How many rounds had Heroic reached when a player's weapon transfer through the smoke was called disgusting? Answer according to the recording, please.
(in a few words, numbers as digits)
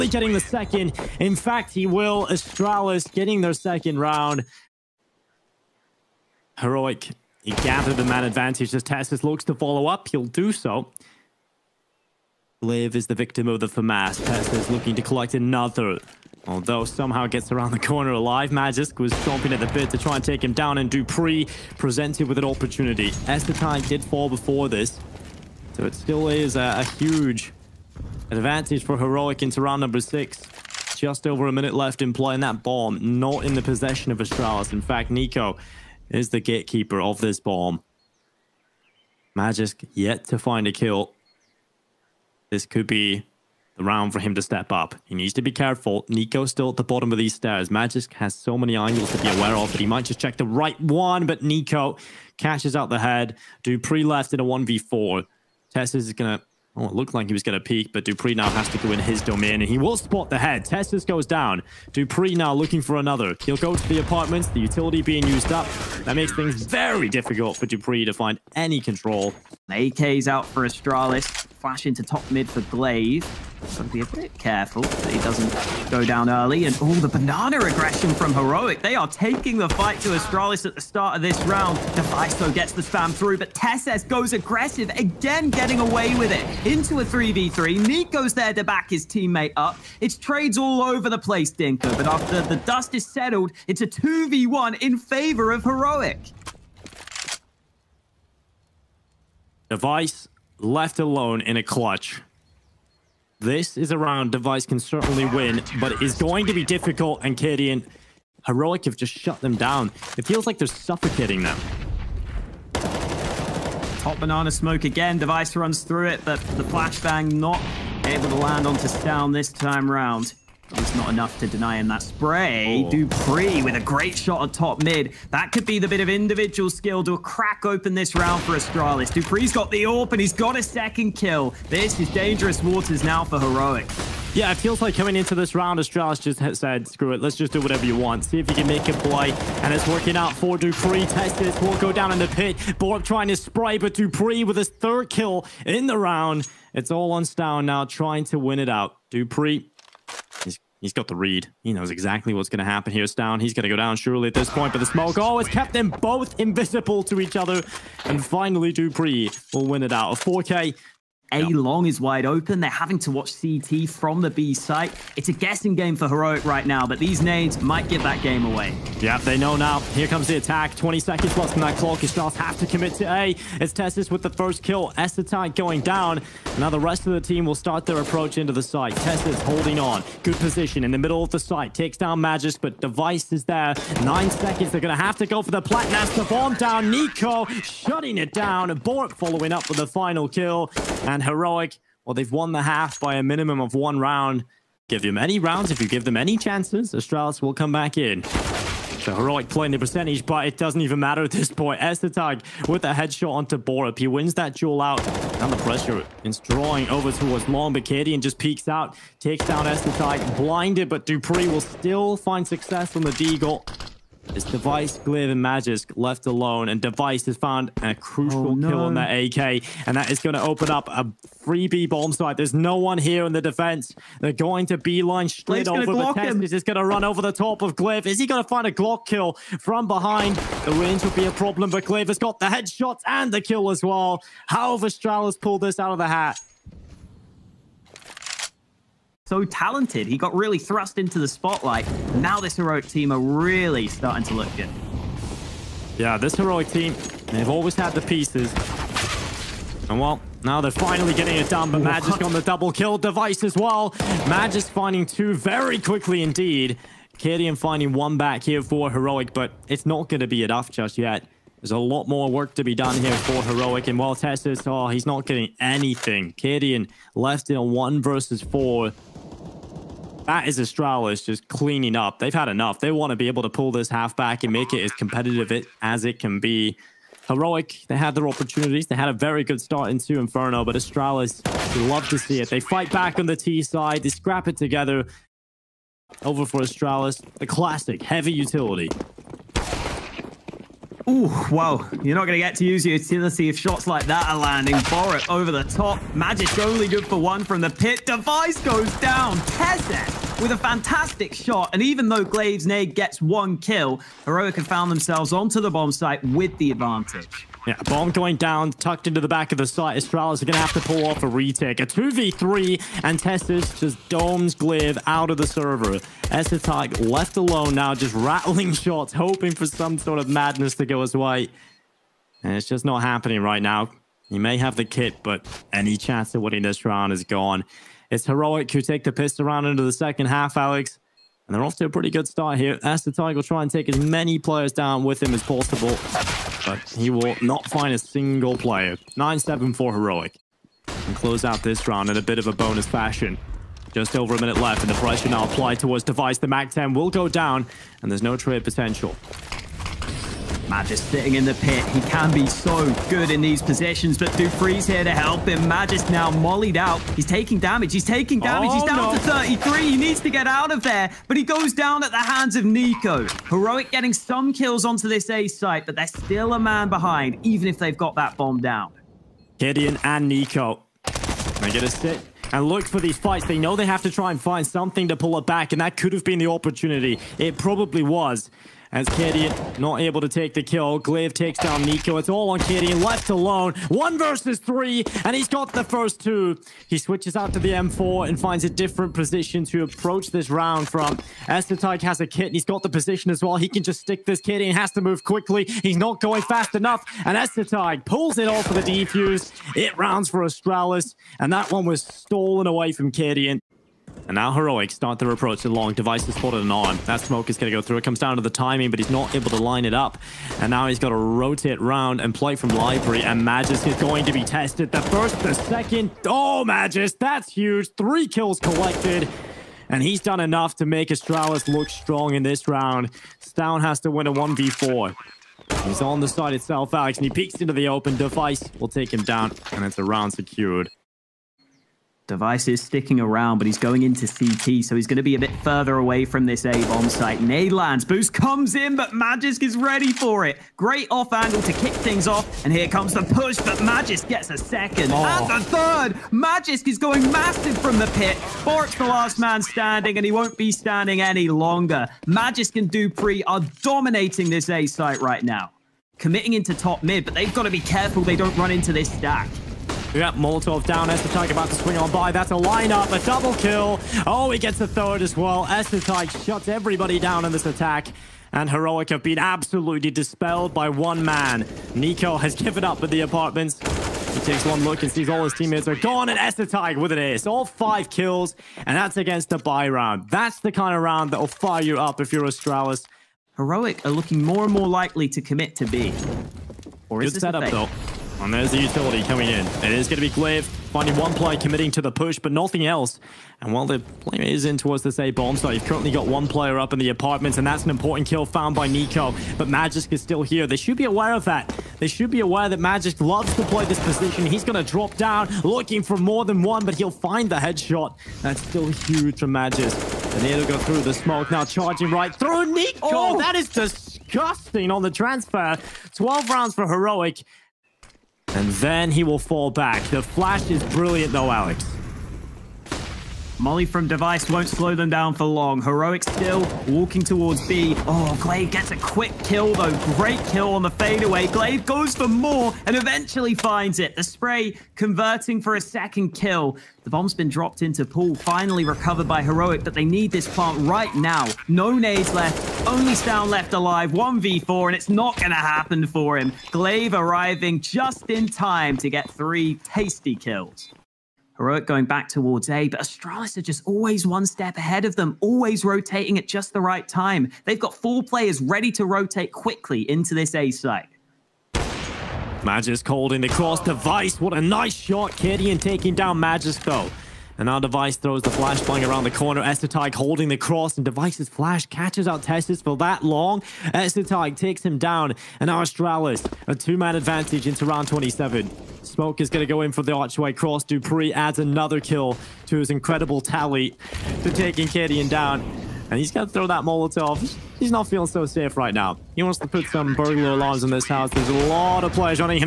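12.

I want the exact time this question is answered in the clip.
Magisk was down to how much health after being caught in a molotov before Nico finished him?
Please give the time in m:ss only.
5:59.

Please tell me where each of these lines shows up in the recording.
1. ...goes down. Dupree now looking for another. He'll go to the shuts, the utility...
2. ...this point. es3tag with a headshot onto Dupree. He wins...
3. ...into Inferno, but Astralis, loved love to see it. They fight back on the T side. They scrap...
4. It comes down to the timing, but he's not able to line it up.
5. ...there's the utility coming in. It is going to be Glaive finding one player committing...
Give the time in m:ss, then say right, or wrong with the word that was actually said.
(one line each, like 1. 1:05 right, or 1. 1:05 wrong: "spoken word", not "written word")
1. 1:01 wrong: "apartments", not "shuts"
2. 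3:21 wrong: "Borup", not "Dupree"
3. 4:39 right
4. 6:47 right
5. 8:08 right.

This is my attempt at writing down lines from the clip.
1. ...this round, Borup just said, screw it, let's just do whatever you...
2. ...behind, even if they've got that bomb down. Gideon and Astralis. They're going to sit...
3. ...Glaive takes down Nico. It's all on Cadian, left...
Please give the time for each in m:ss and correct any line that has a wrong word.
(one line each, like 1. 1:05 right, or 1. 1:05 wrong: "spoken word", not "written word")
1. 2:15 wrong: "Astralis", not "Borup"
2. 6:06 wrong: "Nico", not "Astralis"
3. 6:20 right.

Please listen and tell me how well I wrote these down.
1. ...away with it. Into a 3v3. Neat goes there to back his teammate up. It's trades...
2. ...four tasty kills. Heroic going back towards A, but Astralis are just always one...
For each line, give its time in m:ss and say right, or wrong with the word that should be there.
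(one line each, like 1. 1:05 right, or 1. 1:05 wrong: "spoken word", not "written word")
1. 1:25 right
2. 9:09 wrong: "three", not "four".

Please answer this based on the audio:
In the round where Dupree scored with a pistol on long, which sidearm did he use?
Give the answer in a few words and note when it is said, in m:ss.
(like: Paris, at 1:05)
Deagle, at 3:33.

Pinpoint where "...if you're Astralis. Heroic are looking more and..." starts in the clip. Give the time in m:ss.
8:02.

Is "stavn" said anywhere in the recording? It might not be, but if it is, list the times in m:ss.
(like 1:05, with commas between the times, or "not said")
1:58, 2:27, 7:03, 9:03.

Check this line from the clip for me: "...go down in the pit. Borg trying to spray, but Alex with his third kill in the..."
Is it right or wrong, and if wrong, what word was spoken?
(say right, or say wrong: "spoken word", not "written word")
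wrong: "Dupree", not "Alex".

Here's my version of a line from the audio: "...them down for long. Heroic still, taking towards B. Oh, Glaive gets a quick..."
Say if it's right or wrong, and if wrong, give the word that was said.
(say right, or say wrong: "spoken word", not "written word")
wrong: "walking", not "taking".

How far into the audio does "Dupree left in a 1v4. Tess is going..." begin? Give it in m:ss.
0:53.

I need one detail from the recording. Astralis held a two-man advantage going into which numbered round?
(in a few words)
27.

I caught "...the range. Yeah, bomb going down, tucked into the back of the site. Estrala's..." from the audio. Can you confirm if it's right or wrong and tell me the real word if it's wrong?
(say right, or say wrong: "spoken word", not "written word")
wrong: "advantage", not "range".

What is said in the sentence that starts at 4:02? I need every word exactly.
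Now this heroic team are really starting to look good.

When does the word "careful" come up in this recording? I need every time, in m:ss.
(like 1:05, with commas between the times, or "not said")
0:45, 1:14, 7:37.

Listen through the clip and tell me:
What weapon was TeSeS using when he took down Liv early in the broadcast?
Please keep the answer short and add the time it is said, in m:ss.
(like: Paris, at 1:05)
FAMAS, at 0:13.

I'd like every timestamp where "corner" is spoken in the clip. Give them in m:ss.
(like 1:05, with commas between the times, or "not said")
0:17, 9:29.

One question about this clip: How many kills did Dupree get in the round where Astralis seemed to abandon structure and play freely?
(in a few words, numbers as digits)
4.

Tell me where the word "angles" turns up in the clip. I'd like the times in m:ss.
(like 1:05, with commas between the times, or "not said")
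0:48, 7:21.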